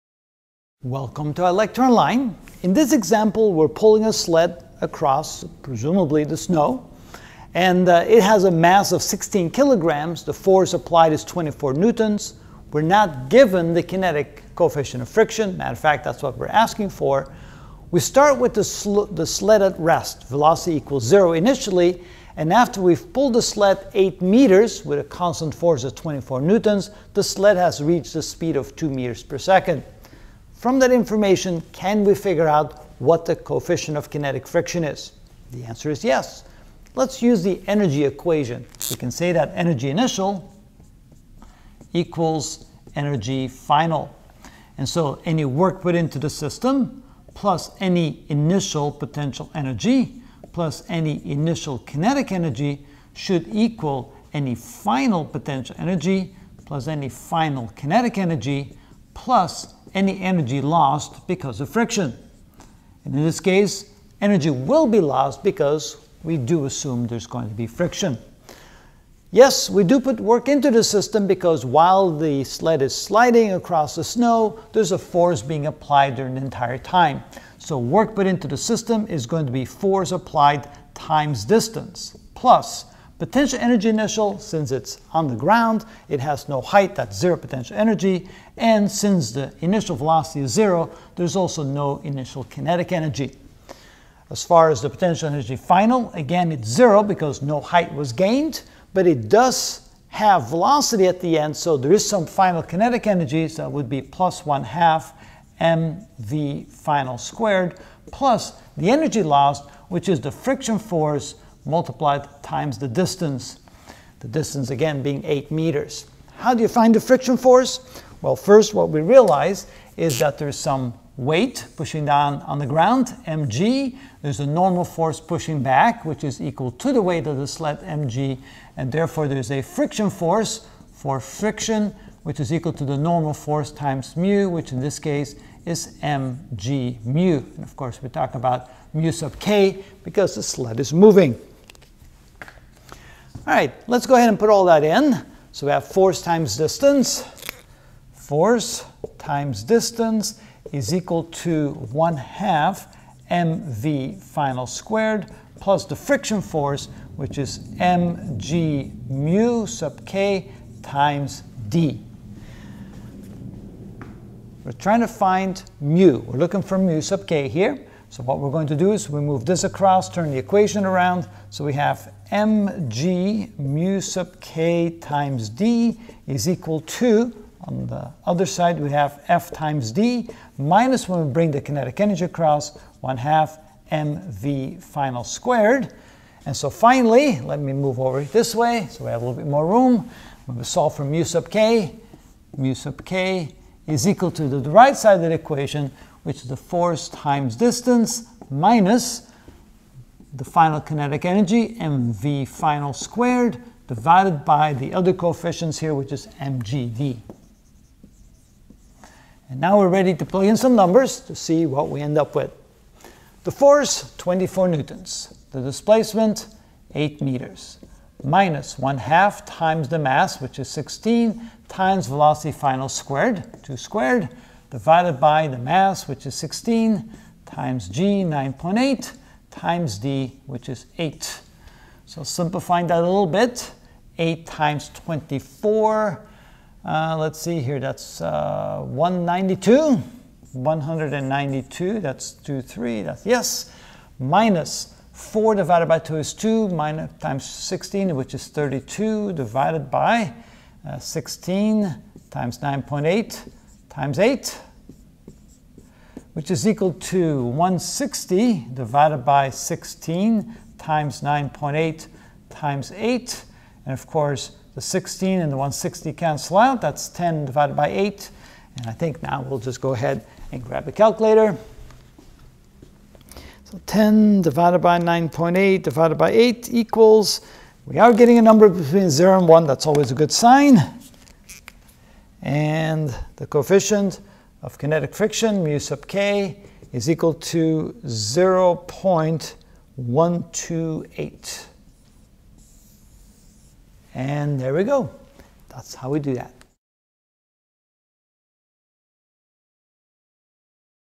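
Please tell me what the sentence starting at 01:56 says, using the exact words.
How do you find the friction force?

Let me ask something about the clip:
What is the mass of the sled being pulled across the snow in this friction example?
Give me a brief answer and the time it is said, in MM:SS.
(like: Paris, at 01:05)
16 kilograms, at 00:09.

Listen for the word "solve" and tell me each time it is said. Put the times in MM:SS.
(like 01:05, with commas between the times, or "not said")
03:10.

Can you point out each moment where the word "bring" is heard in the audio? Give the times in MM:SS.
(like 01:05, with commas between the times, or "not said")
03:01.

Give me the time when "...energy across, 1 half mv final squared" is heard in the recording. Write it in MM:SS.
03:02.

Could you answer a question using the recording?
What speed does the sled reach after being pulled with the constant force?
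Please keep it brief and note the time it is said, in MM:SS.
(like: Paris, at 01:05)
2 meters per second, at 00:28.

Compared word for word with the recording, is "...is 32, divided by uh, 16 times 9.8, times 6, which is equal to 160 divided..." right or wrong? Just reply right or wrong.
wrong.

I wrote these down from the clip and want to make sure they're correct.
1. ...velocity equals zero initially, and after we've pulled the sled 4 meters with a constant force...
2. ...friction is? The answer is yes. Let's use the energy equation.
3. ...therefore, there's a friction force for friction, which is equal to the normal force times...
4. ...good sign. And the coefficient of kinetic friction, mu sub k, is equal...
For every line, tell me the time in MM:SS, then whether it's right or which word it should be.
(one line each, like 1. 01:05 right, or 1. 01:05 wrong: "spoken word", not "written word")
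1. 00:20 wrong: "8", not "4"
2. 00:34 right
3. 02:08 right
4. 04:40 right.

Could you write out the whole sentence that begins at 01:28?
And since the initial velocity is zero, there's also no initial kinetic energy.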